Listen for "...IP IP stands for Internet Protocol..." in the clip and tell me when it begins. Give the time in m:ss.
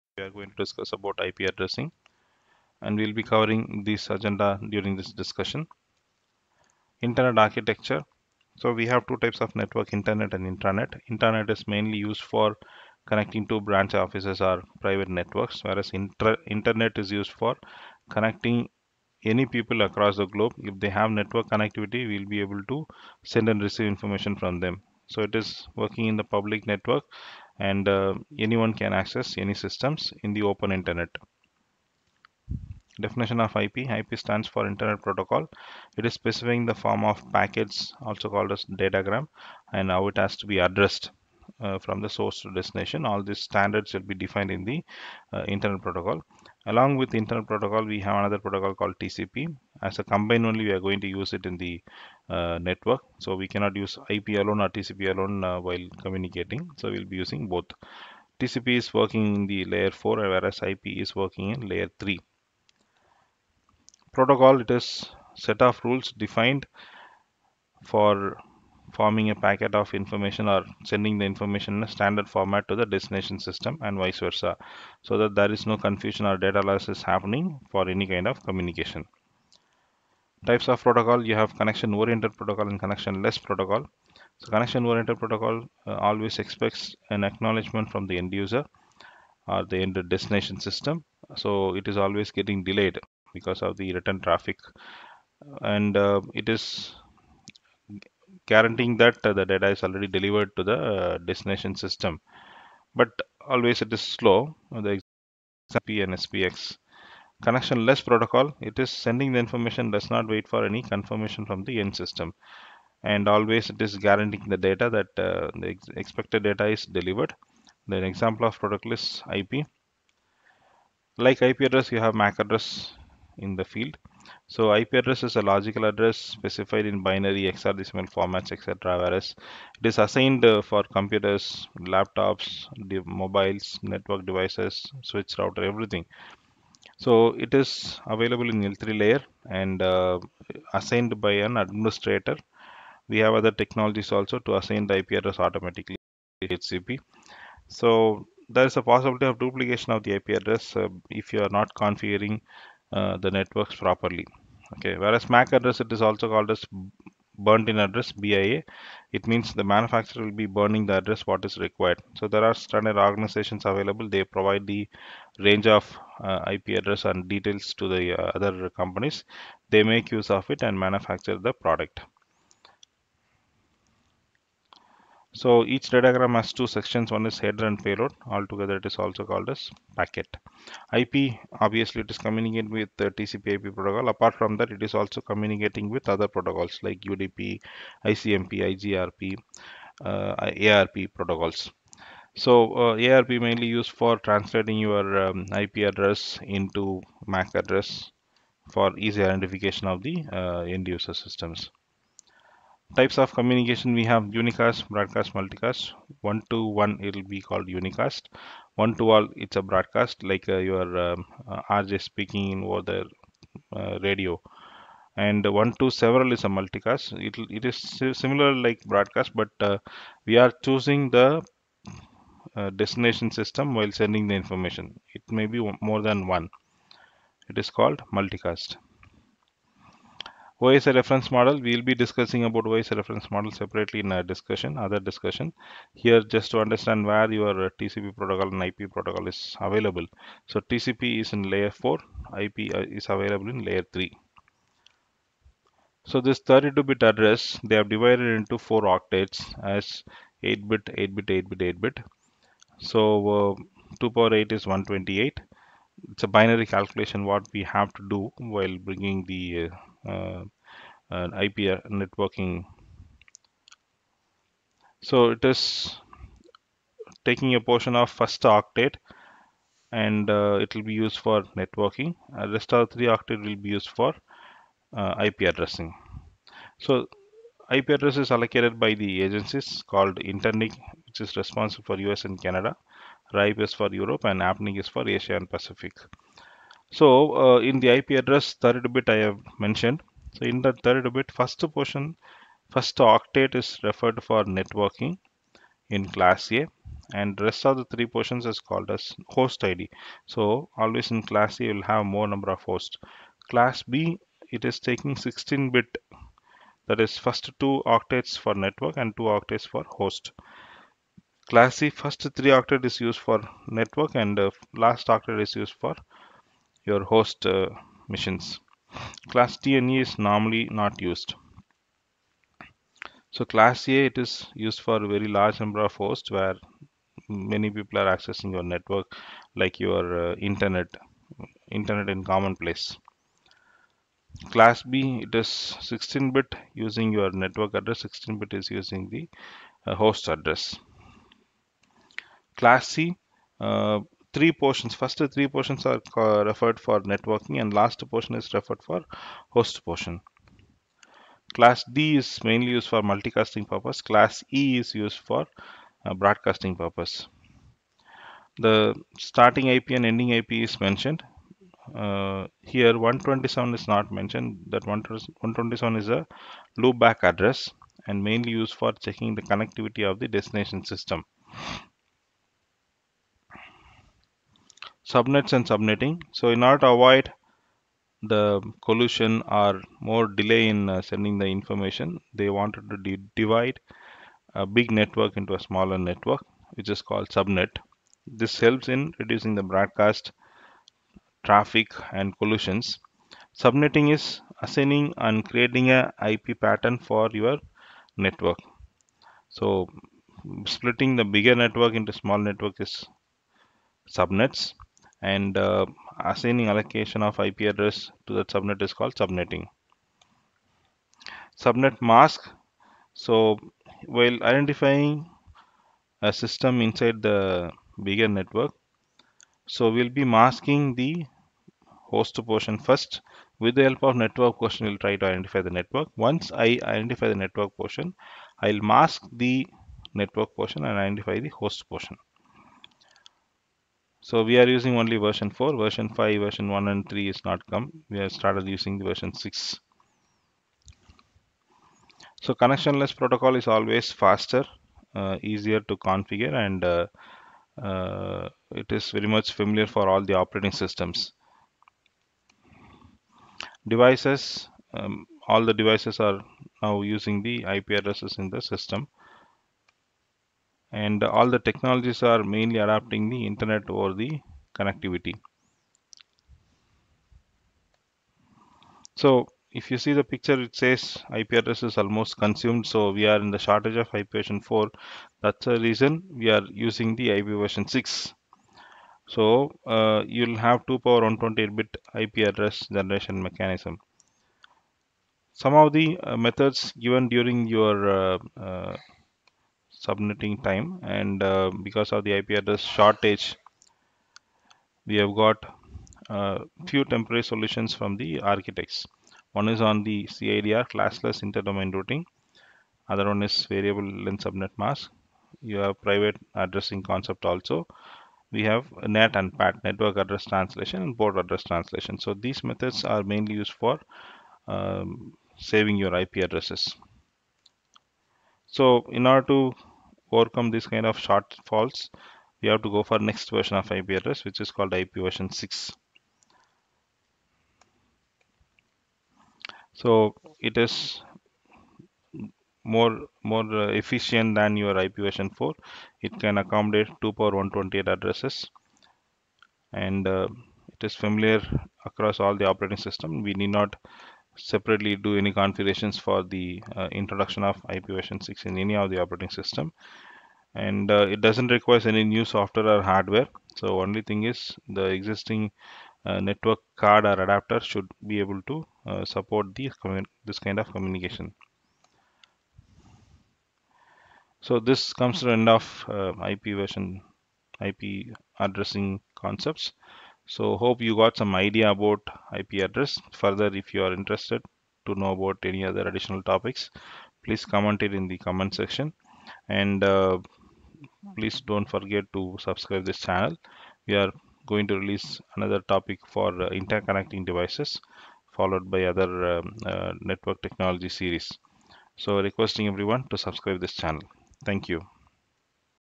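0:33.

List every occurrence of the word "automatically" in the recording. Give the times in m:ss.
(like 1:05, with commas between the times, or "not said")
2:25.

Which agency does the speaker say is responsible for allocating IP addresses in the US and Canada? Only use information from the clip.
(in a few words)
InterNIC.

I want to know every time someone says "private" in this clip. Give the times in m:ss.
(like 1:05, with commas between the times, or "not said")
0:14, 8:26.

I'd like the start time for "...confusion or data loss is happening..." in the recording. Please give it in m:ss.
1:15.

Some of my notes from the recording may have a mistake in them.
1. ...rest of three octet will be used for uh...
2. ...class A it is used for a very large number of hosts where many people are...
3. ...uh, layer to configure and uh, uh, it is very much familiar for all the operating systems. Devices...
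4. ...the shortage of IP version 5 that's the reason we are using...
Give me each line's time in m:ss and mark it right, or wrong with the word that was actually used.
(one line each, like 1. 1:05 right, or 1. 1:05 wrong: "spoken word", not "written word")
1. 4:32 right
2. 5:23 right
3. 7:25 wrong: "easier", not "layer"
4. 7:53 wrong: "4", not "5".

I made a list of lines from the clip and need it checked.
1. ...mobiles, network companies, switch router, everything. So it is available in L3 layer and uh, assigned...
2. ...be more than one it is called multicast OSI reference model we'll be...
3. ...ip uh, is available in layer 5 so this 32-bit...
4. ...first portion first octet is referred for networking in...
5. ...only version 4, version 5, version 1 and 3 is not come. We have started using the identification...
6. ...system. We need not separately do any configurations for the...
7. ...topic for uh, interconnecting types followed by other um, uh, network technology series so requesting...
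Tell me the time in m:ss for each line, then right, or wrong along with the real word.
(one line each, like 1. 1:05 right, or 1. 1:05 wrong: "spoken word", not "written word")
1. 2:13 wrong: "devices", not "companies"
2. 3:45 right
3. 4:02 wrong: "3", not "5"
4. 4:51 right
5. 7:14 wrong: "version", not "identification"
6. 9:02 right
7. 9:45 wrong: "devices", not "types".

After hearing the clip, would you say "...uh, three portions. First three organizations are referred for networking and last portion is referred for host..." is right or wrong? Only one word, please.
wrong.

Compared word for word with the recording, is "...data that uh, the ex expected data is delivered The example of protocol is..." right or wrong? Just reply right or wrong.
right.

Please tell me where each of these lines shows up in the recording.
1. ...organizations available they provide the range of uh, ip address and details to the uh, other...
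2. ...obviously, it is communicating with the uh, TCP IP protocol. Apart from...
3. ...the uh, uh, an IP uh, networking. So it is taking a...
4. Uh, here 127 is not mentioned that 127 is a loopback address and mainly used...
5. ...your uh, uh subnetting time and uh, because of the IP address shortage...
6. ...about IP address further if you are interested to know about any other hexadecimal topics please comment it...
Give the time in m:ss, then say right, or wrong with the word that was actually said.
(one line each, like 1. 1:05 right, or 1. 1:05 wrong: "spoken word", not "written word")
1. 2:42 right
2. 3:01 right
3. 4:19 right
4. 6:01 right
5. 8:07 right
6. 9:31 wrong: "additional", not "hexadecimal".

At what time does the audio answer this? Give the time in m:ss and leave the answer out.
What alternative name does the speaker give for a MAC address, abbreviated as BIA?
2:37.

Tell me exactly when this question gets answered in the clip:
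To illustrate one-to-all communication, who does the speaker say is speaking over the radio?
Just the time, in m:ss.
3:31.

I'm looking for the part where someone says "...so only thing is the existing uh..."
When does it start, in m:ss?
9:13.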